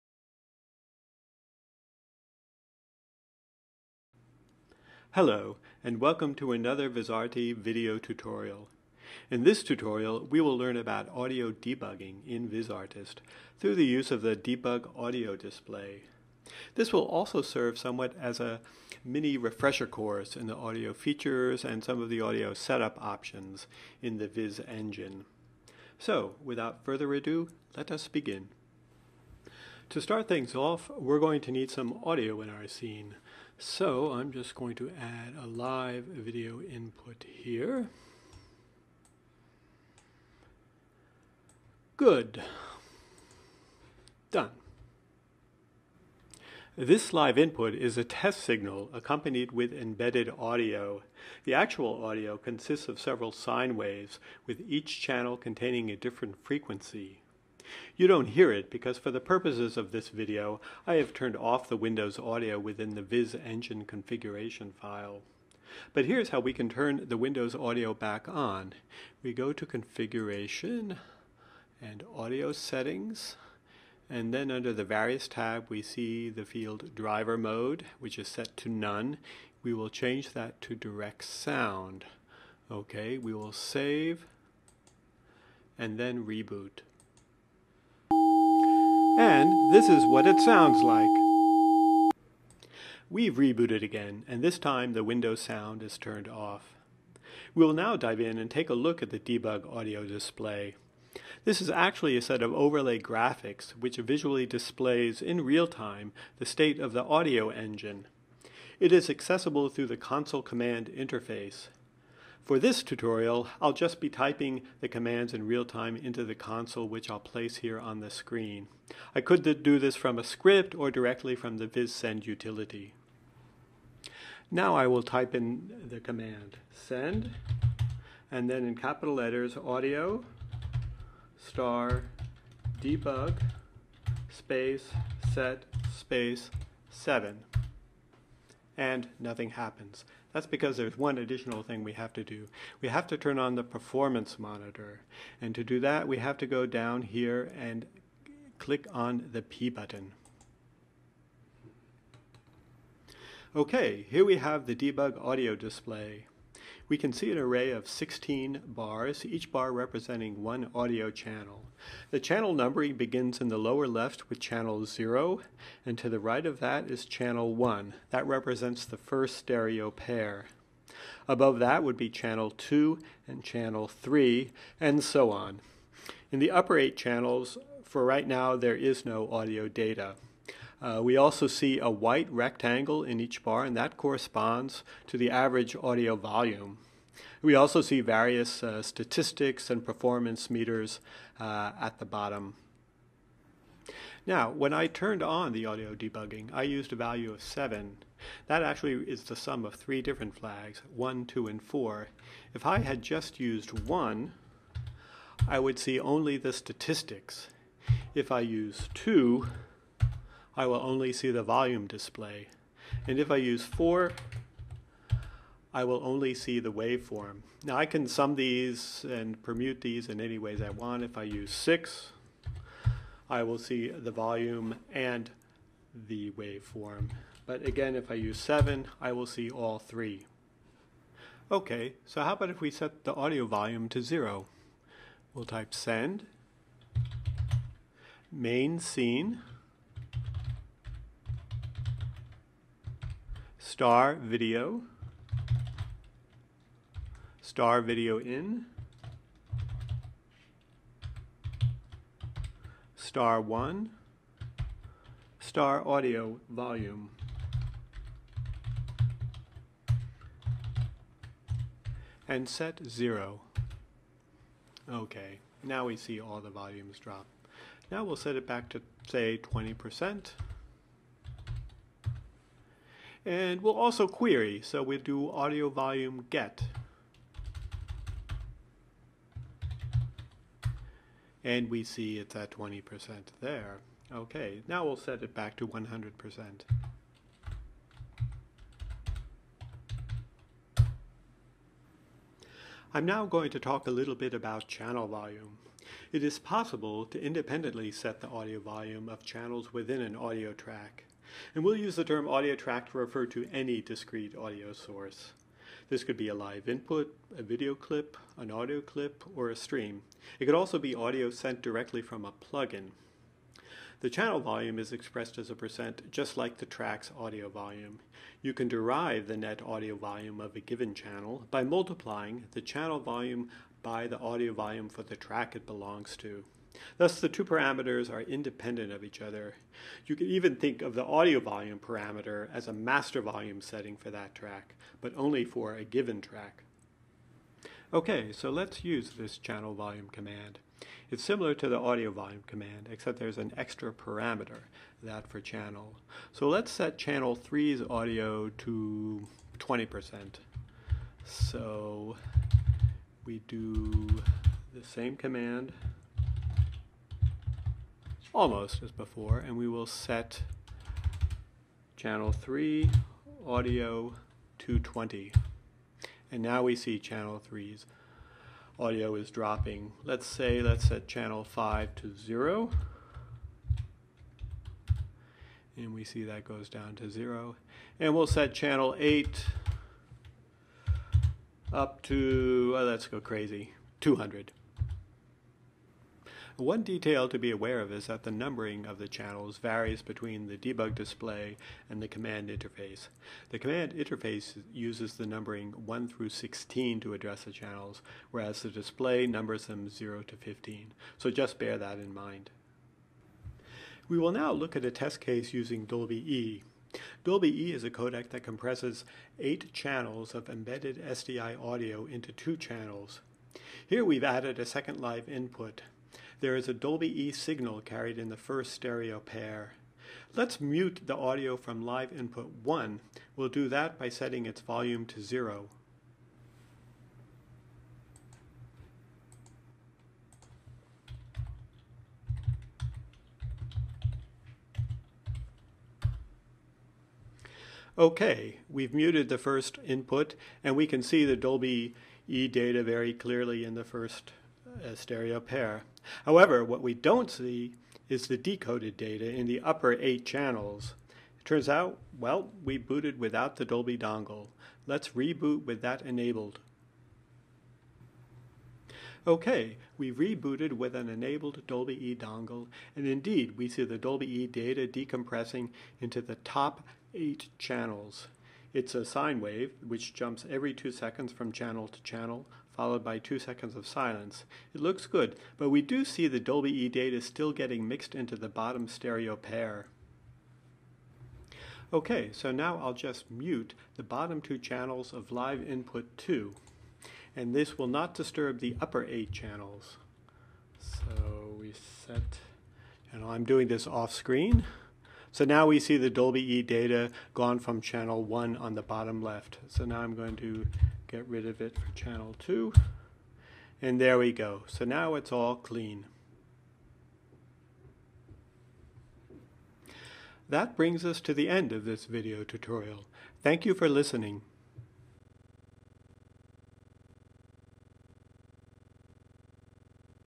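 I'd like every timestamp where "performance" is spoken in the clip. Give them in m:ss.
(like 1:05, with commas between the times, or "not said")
2:23, 3:09.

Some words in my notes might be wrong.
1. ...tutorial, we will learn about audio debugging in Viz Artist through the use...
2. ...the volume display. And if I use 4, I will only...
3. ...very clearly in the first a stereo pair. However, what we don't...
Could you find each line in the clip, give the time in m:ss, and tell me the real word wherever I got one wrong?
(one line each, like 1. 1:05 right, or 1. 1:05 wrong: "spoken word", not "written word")
1. 0:09 right
2. 3:31 right
3. 7:22 right.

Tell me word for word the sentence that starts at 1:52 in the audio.
For this tutorial, I'll just be typing the commands in real time into the console, which I'll place here on the screen.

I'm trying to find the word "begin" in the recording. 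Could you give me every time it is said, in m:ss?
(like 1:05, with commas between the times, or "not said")
0:28, 2:42.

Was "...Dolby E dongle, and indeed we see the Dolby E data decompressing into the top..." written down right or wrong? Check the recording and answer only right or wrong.
right.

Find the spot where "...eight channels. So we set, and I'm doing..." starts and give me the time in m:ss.
8:09.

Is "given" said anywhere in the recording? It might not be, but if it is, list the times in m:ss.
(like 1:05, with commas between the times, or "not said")
5:20, 5:35.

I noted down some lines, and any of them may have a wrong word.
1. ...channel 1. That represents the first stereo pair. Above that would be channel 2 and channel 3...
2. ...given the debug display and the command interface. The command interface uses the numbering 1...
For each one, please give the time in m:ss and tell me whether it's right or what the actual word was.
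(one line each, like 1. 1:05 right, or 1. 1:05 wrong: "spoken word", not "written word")
1. 2:47 right
2. 6:30 wrong: "between", not "given".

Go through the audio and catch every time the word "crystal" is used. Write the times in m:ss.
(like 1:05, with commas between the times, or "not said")
not said.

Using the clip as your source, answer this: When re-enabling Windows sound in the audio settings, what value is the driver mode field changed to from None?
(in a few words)
Direct Sound.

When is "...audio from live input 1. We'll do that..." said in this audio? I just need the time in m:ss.
7:01.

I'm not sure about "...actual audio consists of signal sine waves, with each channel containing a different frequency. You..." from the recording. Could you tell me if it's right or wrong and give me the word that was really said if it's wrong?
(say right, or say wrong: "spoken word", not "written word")
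wrong: "several", not "signal".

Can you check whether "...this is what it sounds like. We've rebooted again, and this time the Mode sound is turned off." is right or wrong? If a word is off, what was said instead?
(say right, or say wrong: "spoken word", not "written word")
wrong: "Windows", not "Mode".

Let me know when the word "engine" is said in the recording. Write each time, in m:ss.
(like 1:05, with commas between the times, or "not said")
0:24, 1:03, 1:47.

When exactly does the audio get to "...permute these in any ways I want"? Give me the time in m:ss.
3:39.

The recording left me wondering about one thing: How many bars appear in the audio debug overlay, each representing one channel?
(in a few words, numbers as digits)
16.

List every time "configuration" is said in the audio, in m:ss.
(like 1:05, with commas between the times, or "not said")
1:03, 1:09.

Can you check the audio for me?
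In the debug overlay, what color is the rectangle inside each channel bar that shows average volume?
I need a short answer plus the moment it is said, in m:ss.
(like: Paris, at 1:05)
White, at 3:01.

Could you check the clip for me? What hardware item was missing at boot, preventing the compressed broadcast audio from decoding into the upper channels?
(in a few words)
Dolby dongle.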